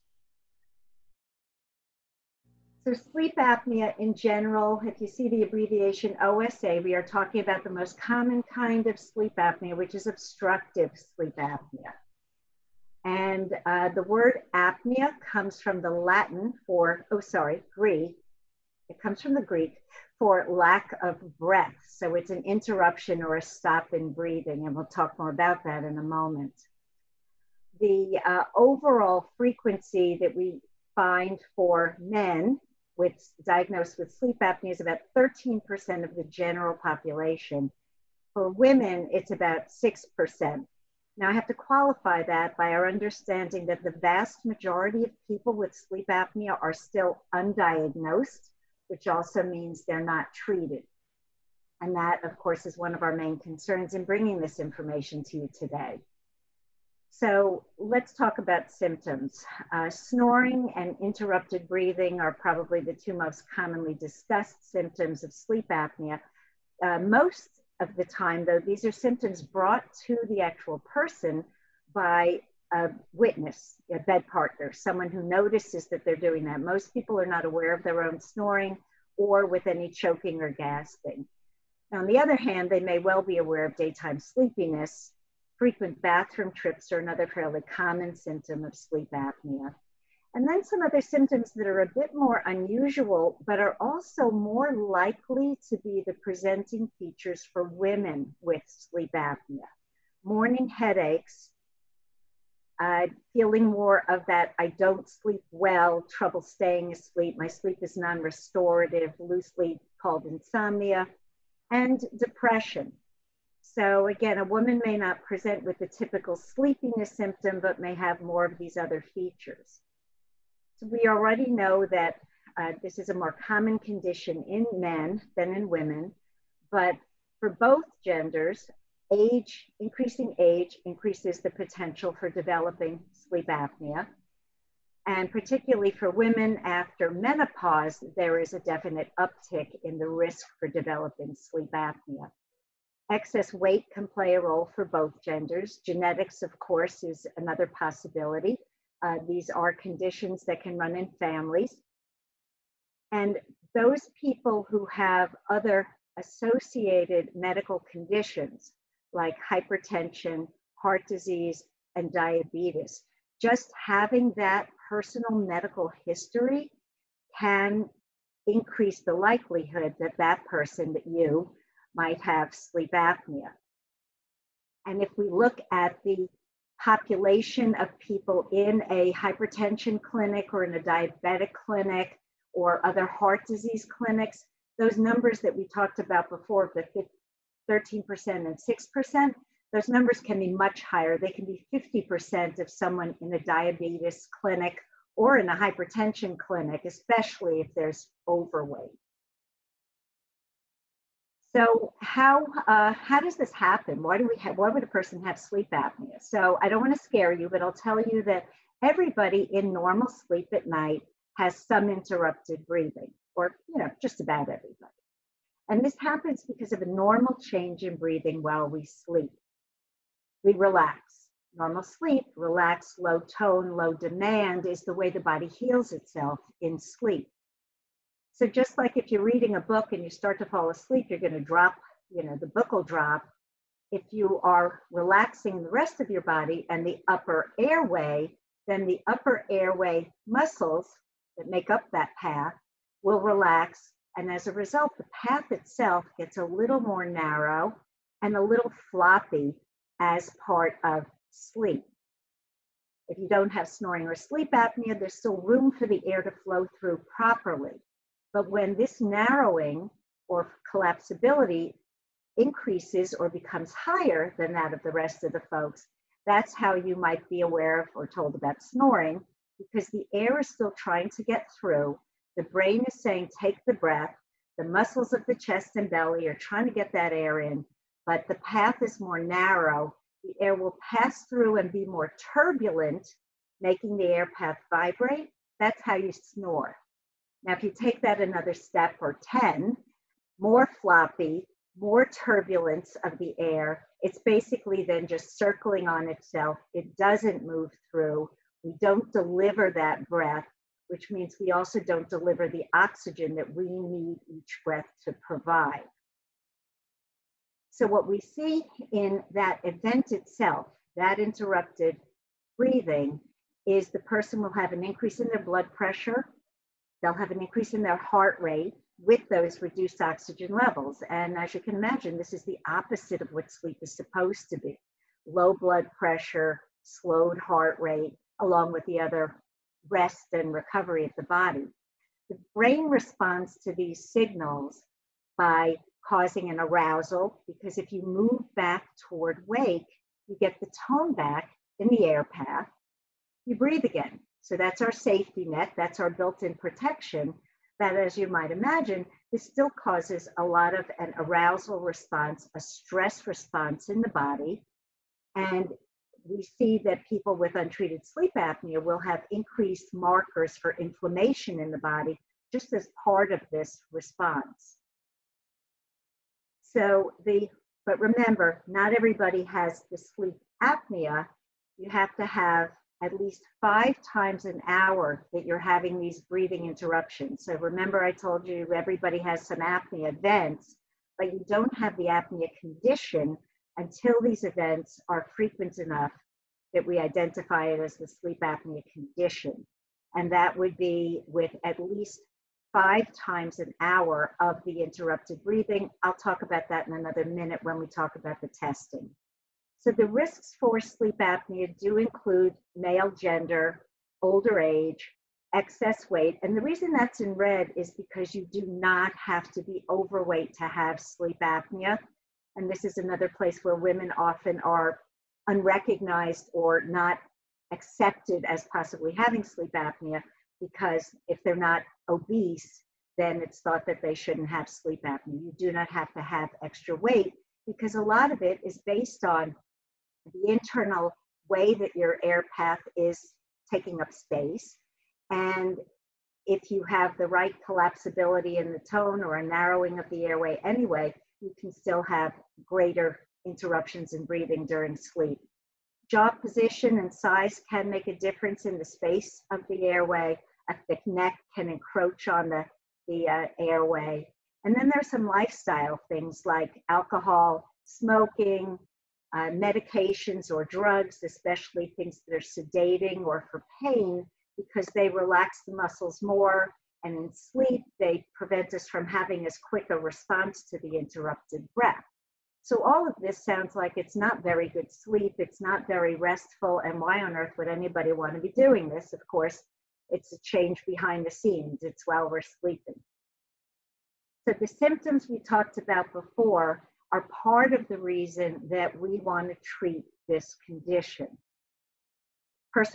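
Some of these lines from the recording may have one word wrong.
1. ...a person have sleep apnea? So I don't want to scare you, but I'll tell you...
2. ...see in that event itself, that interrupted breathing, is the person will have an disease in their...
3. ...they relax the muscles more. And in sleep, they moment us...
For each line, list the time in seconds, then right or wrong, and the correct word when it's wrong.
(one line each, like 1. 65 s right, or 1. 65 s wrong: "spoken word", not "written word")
1. 204 s right
2. 308 s wrong: "increase", not "disease"
3. 464 s wrong: "prevent", not "moment".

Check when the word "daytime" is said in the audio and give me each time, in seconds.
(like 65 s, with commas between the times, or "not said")
83 s.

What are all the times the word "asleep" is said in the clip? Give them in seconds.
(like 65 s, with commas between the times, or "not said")
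106 s, 230 s.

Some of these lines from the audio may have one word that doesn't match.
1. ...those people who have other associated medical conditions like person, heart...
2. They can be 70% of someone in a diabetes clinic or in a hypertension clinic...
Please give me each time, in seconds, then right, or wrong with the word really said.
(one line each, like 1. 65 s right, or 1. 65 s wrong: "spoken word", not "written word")
1. 153 s wrong: "hypertension", not "person"
2. 191 s wrong: "50", not "70".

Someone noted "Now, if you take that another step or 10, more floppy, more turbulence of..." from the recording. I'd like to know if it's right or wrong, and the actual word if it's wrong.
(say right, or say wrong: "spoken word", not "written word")
right.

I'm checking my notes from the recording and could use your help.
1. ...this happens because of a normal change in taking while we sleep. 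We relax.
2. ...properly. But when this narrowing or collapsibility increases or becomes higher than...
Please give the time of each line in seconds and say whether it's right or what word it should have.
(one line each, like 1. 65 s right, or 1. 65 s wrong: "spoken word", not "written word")
1. 215 s wrong: "breathing", not "taking"
2. 257 s right.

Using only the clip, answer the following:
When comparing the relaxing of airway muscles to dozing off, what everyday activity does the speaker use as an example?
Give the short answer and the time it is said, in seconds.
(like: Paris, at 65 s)
reading a book, at 229 s.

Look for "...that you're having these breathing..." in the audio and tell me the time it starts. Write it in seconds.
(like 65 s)
375 s.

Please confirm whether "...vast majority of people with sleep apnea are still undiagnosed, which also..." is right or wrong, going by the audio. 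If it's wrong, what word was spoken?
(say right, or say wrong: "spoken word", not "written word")
right.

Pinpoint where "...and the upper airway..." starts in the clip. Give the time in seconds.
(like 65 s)
236 s.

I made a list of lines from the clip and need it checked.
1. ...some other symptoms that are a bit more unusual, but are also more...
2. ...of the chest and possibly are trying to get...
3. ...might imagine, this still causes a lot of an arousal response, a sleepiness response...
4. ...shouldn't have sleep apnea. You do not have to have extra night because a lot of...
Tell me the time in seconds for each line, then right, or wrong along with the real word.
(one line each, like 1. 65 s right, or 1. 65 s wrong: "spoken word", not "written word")
1. 90 s right
2. 275 s wrong: "belly", not "possibly"
3. 348 s wrong: "stress", not "sleepiness"
4. 424 s wrong: "weight", not "night".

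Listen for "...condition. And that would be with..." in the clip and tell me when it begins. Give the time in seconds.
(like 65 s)
388 s.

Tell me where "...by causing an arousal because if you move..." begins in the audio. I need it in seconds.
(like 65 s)
335 s.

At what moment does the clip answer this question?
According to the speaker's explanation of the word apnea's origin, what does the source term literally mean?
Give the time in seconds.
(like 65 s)
20 s.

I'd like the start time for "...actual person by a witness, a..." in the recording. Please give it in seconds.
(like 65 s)
70 s.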